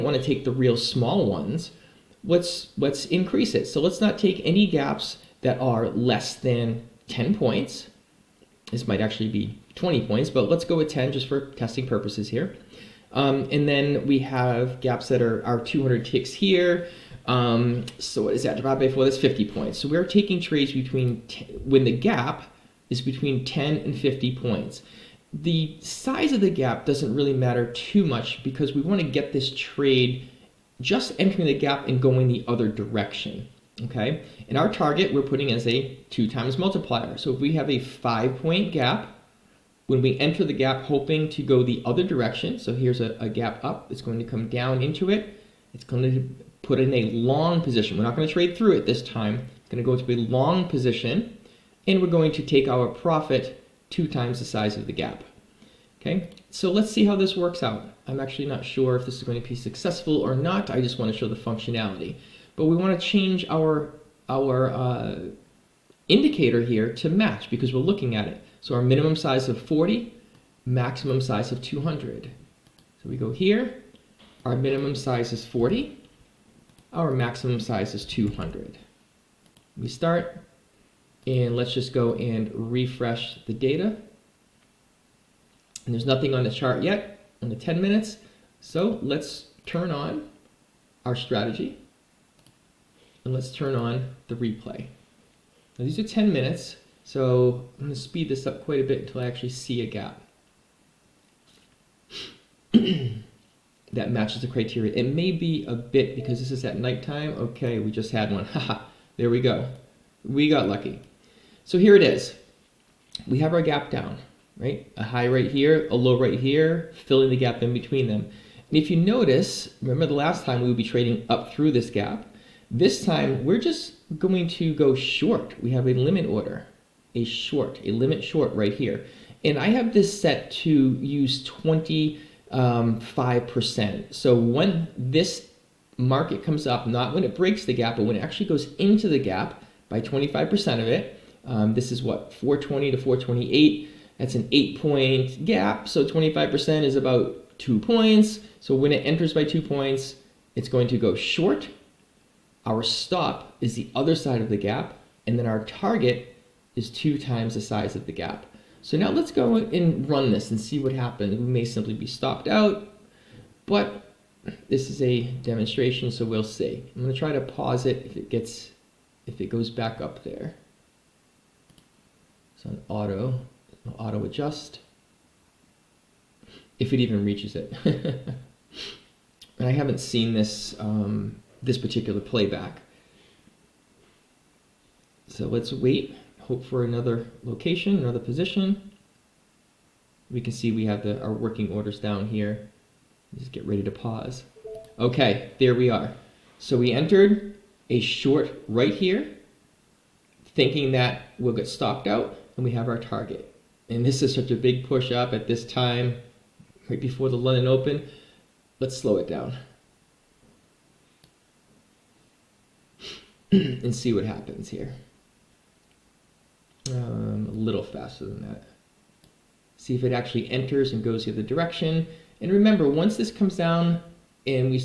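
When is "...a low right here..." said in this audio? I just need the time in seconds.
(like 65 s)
115 s.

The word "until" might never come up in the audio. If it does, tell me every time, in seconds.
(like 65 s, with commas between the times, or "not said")
99 s.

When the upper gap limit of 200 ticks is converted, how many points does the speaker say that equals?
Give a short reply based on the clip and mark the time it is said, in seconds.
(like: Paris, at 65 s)
50 points, at 19 s.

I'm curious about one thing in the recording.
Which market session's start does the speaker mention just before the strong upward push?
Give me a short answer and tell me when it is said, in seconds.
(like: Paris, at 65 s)
London Open, at 207 s.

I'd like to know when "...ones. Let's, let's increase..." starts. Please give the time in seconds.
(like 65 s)
1 s.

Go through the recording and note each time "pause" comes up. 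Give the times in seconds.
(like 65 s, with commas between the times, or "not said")
167 s, 193 s.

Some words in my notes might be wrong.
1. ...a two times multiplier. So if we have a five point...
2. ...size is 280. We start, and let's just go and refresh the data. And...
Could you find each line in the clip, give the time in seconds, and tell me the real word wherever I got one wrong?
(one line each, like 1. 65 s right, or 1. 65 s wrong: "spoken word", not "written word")
1. 35 s right
2. 77 s wrong: "200", not "280".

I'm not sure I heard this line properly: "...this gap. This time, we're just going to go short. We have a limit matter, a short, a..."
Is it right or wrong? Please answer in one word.
wrong.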